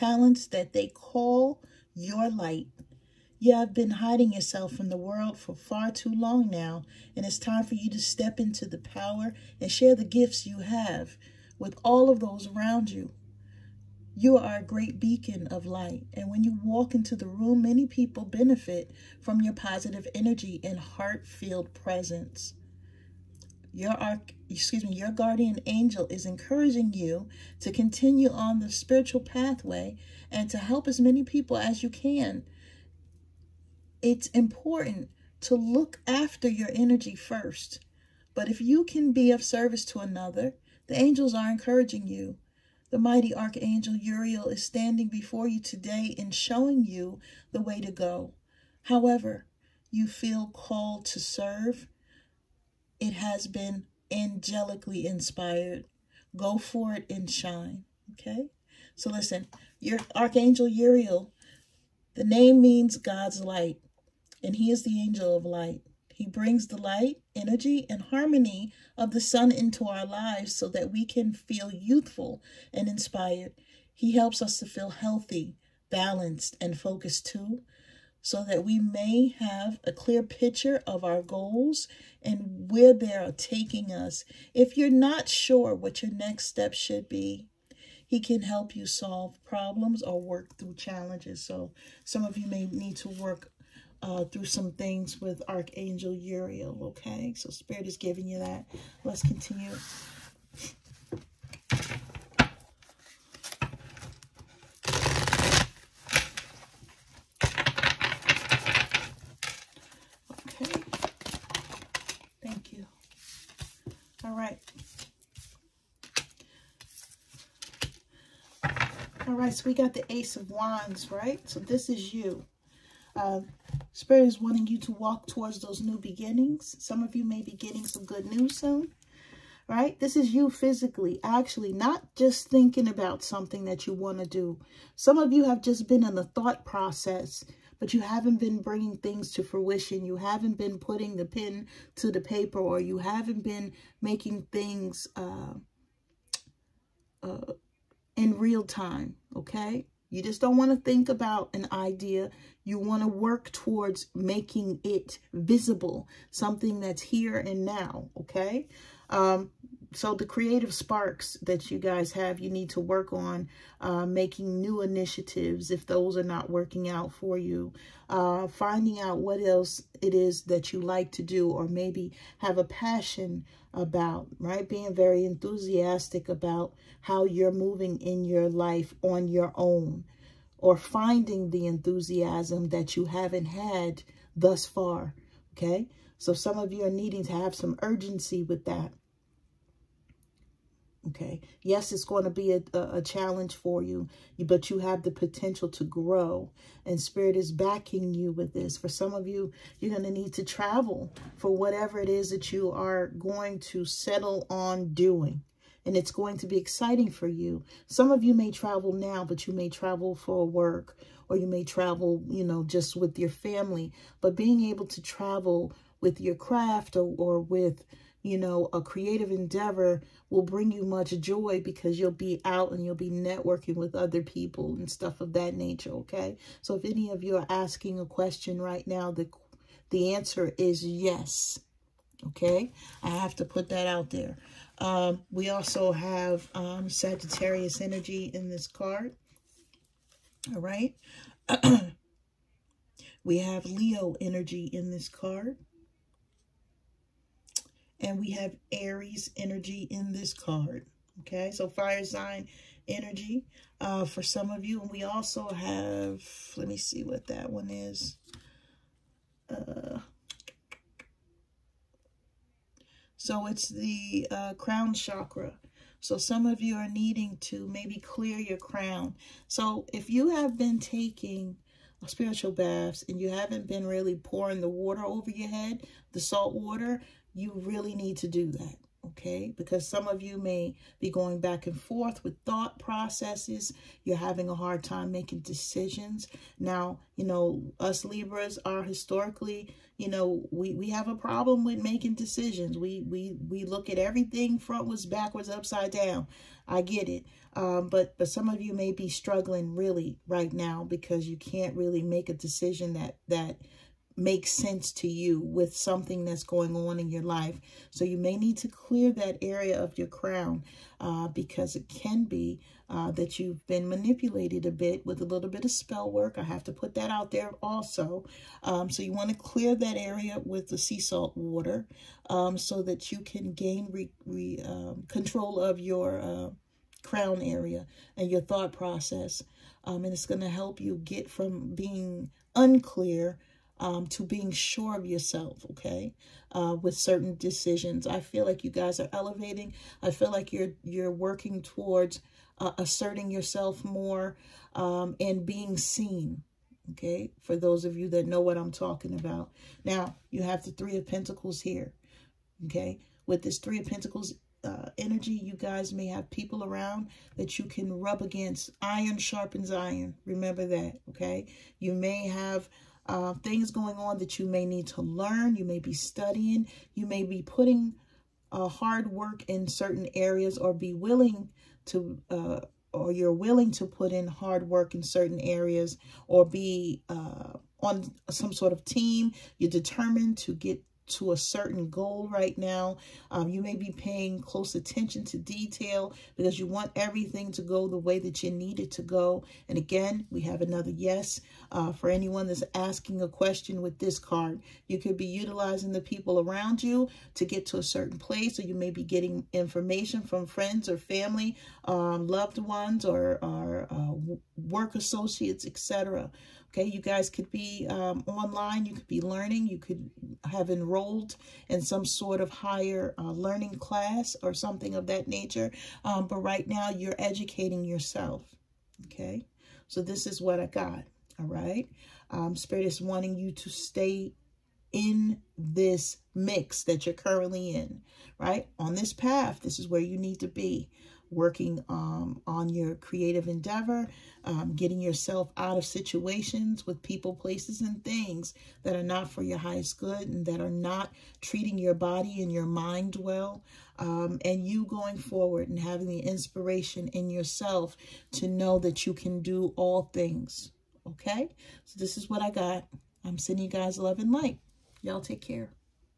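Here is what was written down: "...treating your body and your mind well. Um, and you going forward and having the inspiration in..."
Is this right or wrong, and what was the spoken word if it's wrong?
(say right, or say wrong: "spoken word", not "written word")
right.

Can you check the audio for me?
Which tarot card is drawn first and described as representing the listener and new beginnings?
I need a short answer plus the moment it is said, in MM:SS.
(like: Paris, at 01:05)
Ace of Wands, at 02:00.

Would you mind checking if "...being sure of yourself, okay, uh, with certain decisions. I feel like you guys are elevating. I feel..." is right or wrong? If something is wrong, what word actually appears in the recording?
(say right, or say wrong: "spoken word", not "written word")
right.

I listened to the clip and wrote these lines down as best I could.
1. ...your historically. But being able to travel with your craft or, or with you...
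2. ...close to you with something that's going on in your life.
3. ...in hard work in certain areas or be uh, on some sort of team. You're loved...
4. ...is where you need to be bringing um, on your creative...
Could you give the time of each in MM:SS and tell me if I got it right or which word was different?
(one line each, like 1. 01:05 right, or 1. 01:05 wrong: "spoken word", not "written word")
1. 03:33 wrong: "family", not "historically"
2. 05:04 wrong: "sense", not "close"
3. 06:14 wrong: "determined", not "loved"
4. 07:09 wrong: "working", not "bringing".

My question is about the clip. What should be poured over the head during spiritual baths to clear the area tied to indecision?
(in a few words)
Sea salt water.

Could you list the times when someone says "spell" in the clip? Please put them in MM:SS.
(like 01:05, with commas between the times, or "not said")
05:15.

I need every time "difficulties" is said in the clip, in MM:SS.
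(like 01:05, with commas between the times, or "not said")
not said.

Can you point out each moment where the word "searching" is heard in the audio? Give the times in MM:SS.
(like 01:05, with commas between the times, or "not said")
not said.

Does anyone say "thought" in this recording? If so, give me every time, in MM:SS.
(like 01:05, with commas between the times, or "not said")
02:16, 04:42, 05:28.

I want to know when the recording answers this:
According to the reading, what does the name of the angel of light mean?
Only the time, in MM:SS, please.
01:02.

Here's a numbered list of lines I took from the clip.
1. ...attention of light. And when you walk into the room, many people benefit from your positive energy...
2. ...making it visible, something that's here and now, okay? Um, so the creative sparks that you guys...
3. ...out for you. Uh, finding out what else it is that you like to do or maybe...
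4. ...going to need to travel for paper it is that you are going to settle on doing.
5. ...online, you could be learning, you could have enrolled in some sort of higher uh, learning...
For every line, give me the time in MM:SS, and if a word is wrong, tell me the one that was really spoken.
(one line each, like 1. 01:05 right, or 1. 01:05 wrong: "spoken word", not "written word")
1. 00:14 wrong: "beacon", not "attention"
2. 02:34 right
3. 02:46 right
4. 03:19 wrong: "whatever", not "paper"
5. 06:48 right.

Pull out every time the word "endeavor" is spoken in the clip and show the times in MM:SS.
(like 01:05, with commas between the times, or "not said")
03:39, 07:13.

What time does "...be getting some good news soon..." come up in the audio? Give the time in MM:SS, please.
02:07.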